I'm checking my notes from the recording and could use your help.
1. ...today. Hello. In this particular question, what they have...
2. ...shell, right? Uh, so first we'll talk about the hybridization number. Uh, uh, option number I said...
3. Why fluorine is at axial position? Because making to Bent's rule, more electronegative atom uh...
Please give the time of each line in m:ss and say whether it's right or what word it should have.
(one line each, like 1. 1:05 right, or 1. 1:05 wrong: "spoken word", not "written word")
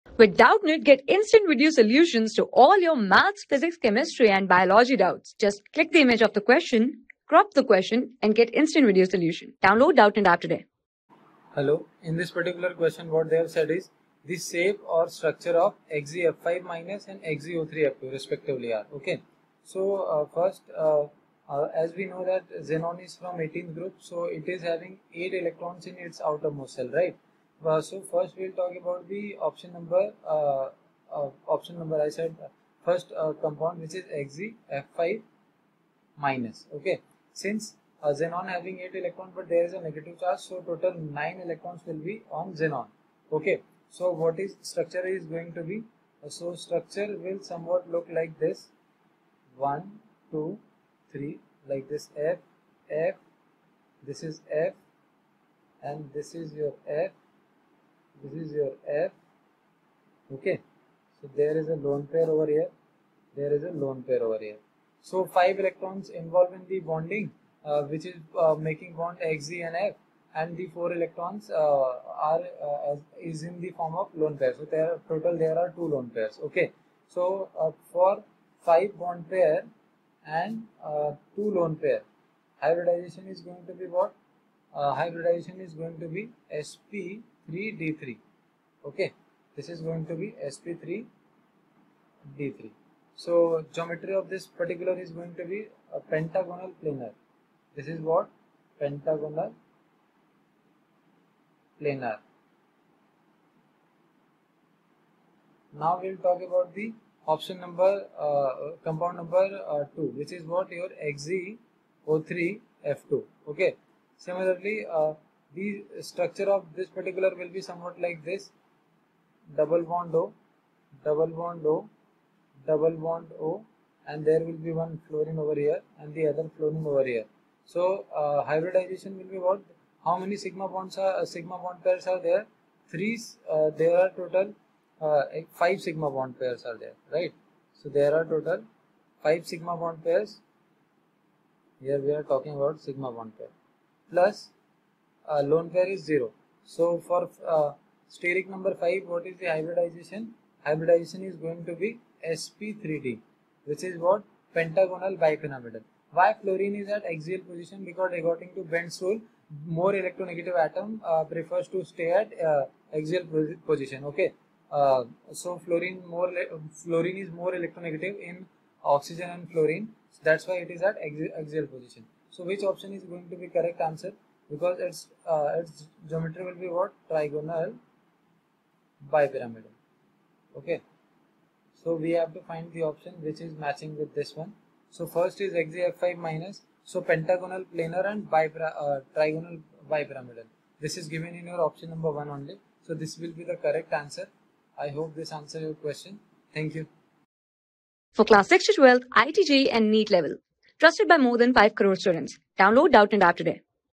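1. 0:10 right
2. 0:26 wrong: "option", not "hybridization"
3. 2:36 wrong: "according", not "making".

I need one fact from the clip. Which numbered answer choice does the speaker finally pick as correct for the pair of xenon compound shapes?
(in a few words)
Option 1.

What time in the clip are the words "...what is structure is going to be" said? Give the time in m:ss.
0:44.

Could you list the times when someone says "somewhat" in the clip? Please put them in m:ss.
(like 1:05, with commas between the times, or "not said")
0:47, 1:57.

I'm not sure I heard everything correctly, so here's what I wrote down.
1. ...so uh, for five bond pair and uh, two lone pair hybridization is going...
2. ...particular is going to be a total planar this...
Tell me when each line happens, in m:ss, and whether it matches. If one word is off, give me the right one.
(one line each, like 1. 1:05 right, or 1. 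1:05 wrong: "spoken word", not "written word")
1. 1:17 right
2. 1:34 wrong: "pentagonal", not "total".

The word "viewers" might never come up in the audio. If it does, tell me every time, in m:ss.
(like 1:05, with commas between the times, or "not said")
not said.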